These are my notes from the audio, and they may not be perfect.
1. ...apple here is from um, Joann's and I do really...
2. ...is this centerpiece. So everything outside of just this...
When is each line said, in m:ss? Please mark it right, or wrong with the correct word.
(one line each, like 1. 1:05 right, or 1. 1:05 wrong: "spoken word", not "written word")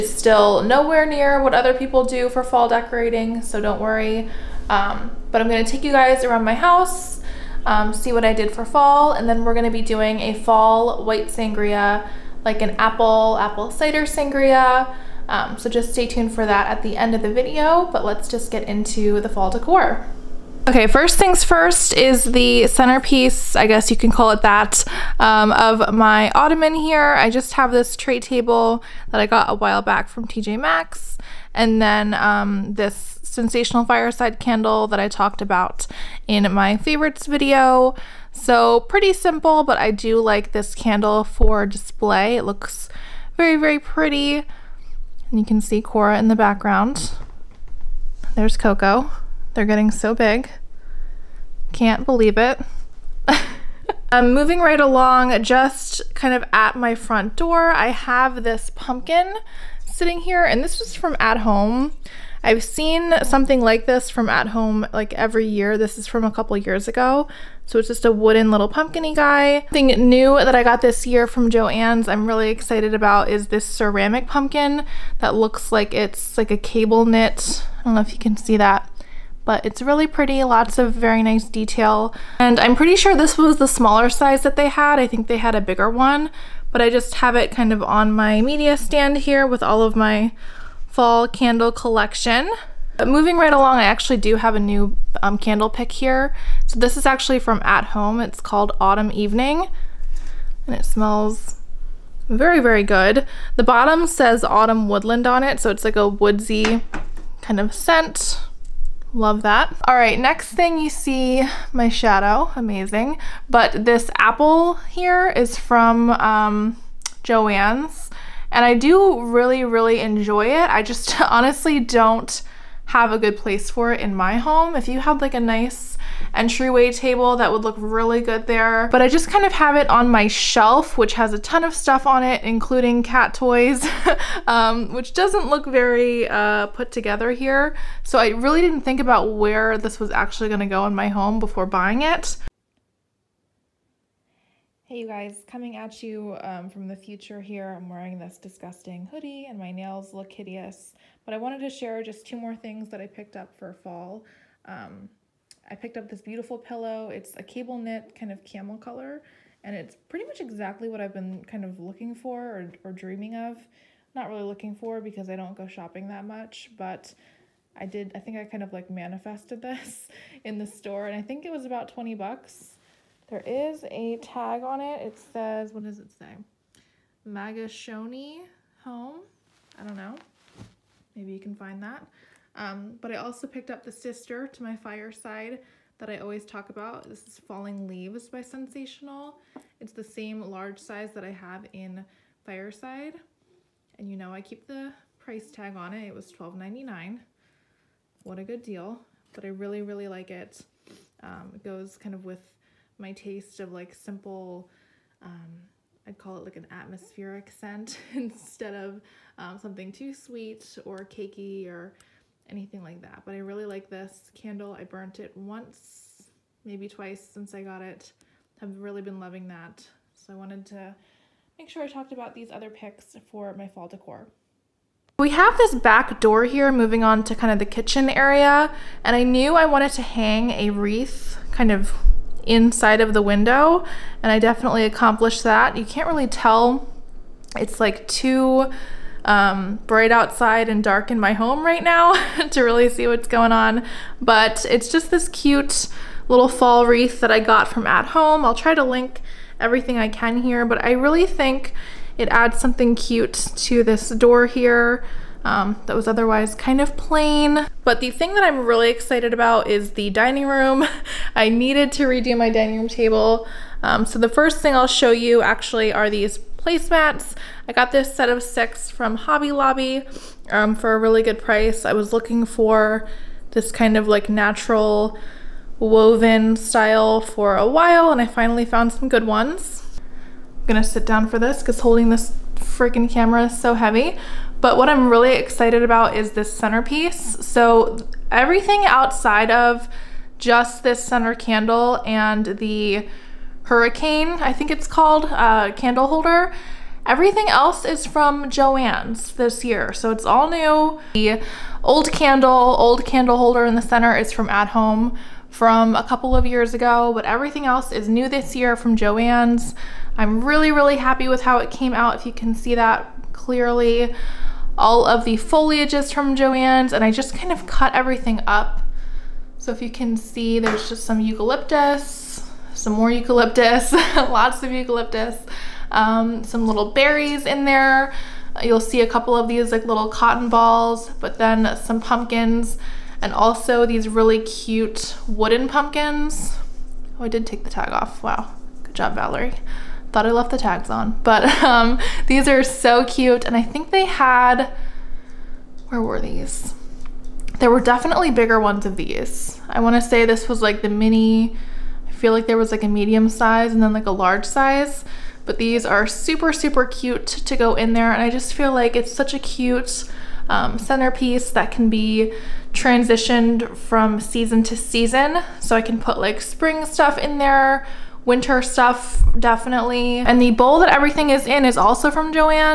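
1. 1:54 right
2. 4:46 right.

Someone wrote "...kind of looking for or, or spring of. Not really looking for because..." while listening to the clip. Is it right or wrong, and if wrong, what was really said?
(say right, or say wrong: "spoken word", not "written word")
wrong: "dreaming", not "spring".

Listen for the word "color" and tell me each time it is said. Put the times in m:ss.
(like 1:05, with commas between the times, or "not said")
2:38.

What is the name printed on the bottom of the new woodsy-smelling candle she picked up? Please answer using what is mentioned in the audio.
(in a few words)
Autumn Woodland.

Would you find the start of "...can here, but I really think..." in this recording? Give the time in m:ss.
4:10.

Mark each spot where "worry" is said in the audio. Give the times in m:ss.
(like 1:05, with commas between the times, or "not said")
0:03.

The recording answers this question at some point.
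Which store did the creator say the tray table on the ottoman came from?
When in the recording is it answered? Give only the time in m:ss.
0:30.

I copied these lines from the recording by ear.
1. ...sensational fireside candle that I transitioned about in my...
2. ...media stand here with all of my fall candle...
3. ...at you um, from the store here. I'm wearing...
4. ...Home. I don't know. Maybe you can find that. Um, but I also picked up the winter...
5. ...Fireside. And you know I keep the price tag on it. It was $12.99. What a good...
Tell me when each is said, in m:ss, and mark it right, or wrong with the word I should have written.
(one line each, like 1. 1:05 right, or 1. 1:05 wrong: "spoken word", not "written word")
1. 0:33 wrong: "talked", not "transitioned"
2. 1:28 right
3. 2:25 wrong: "future", not "store"
4. 2:58 wrong: "sister", not "winter"
5. 3:12 right.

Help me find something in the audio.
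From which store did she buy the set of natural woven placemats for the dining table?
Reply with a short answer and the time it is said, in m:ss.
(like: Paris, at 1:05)
Hobby Lobby, at 4:29.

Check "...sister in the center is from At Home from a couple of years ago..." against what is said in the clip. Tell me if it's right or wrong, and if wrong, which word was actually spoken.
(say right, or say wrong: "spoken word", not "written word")
wrong: "holder", not "sister".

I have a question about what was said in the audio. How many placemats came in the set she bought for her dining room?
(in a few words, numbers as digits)
6.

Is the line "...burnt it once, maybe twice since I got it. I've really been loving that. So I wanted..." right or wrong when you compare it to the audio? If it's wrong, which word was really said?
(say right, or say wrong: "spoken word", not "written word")
right.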